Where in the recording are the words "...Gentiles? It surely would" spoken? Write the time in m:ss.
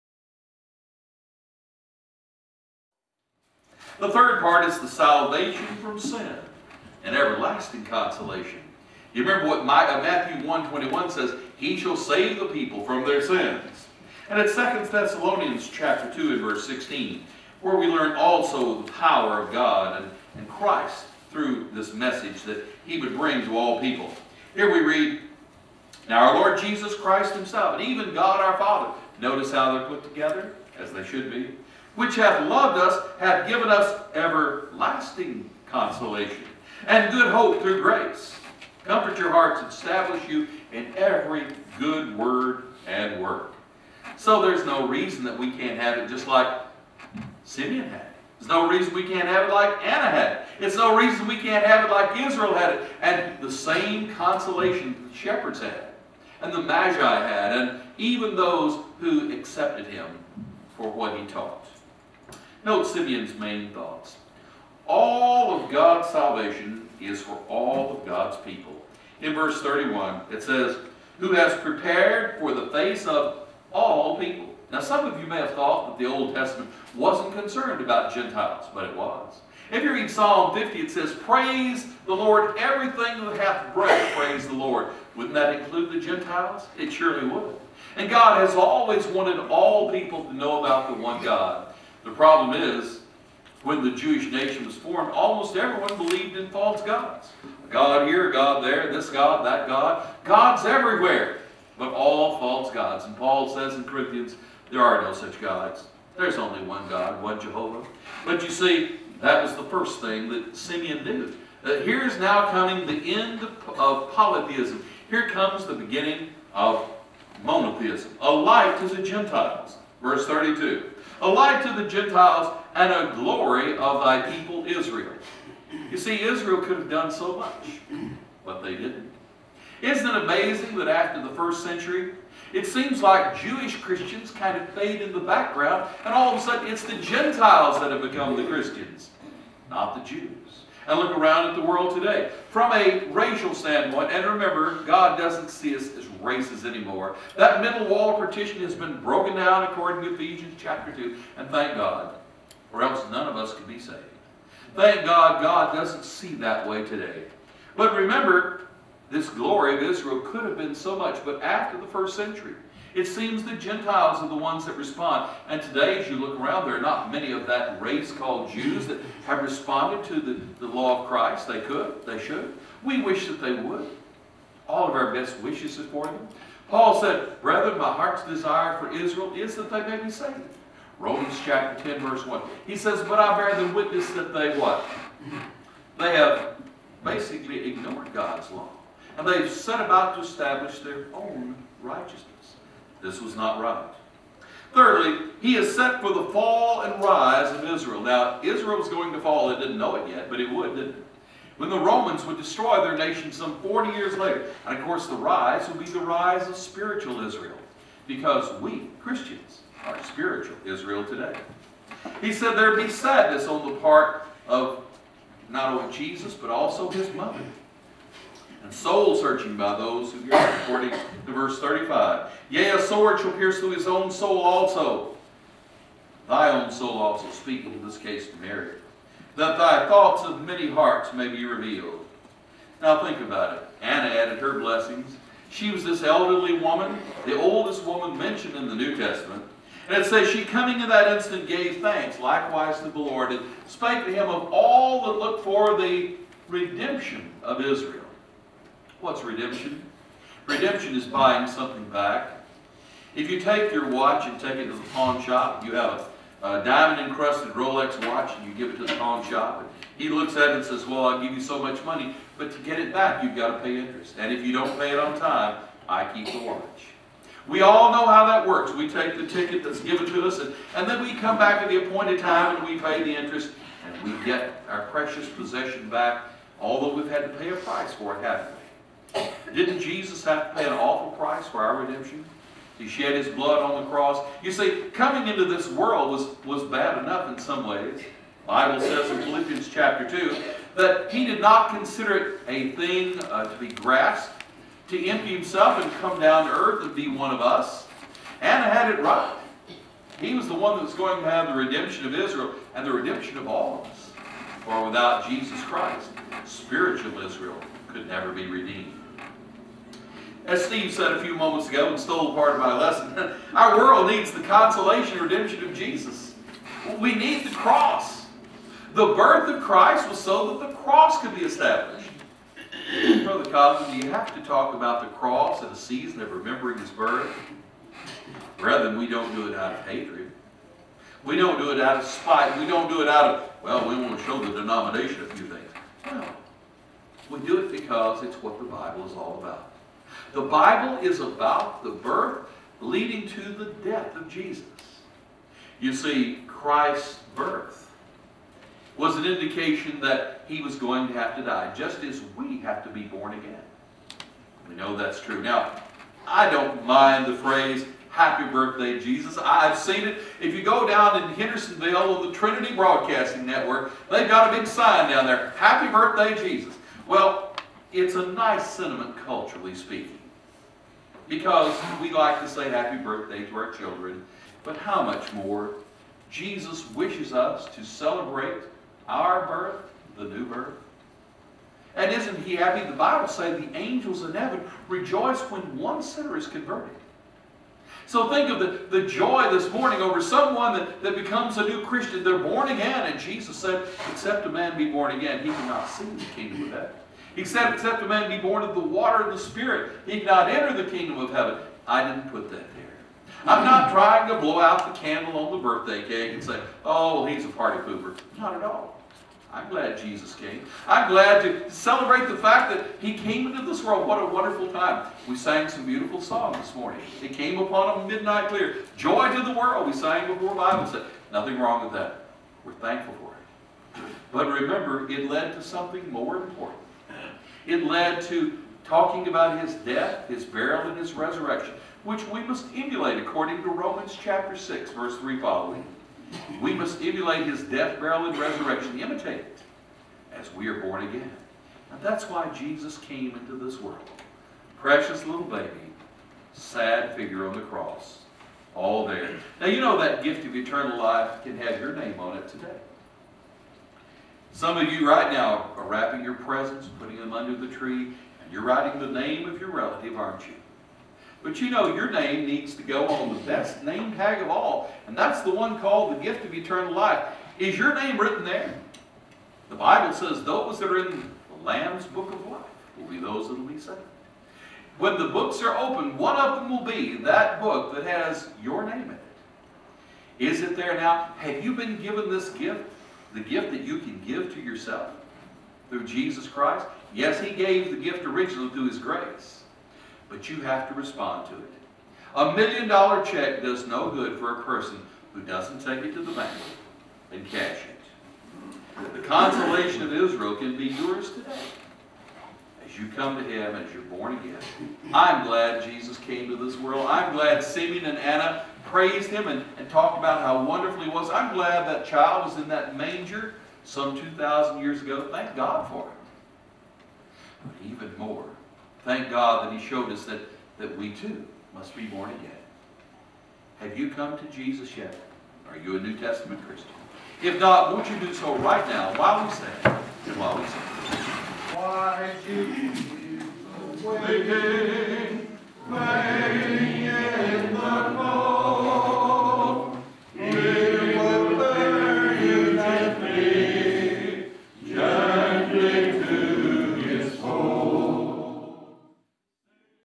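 1:26.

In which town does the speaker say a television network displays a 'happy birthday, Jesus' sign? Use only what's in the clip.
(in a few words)
Hendersonville.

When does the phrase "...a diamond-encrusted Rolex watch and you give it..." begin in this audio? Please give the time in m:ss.
4:16.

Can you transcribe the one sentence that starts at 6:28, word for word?
So think of the, the joy this morning over someone that, that becomes a new Christian.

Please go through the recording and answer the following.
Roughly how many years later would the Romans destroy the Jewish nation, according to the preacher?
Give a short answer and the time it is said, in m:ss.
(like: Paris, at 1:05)
40, at 3:23.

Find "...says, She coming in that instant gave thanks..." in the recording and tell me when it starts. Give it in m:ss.
4:00.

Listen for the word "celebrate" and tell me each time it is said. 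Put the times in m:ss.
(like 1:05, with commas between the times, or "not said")
6:17, 6:51.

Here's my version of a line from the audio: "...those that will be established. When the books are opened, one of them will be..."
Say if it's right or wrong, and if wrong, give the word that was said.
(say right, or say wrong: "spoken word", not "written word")
wrong: "saved", not "established".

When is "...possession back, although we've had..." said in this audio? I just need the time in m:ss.
4:35.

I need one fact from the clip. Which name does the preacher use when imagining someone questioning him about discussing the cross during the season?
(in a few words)
Brother Cosby.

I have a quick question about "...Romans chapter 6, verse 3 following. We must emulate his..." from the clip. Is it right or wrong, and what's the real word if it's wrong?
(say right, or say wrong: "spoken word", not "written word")
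right.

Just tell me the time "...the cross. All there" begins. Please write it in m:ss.
7:27.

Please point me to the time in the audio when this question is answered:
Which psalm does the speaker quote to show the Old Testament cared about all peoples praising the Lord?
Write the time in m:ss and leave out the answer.
1:20.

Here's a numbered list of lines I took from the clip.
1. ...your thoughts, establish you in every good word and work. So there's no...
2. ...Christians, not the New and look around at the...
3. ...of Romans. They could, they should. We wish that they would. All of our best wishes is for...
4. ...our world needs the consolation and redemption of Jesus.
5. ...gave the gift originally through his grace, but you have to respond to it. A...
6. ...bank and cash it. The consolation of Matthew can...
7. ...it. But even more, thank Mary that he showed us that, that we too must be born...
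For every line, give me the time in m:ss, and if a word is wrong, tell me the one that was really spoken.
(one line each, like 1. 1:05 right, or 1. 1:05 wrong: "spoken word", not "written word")
1. 0:39 wrong: "hearts", not "thoughts"
2. 2:18 wrong: "Jews", not "New"
3. 2:51 wrong: "Christ", not "Romans"
4. 5:13 right
5. 8:07 right
6. 8:16 wrong: "Israel", not "Matthew"
7. 8:36 wrong: "God", not "Mary".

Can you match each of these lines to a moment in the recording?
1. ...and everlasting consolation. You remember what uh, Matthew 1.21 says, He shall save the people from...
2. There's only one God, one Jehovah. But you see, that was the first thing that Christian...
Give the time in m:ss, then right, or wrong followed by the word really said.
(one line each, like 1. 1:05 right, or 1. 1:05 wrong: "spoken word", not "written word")
1. 0:07 right
2. 1:46 wrong: "Simeon", not "Christian".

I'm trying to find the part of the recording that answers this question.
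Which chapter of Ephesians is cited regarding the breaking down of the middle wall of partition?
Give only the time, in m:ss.
2:30.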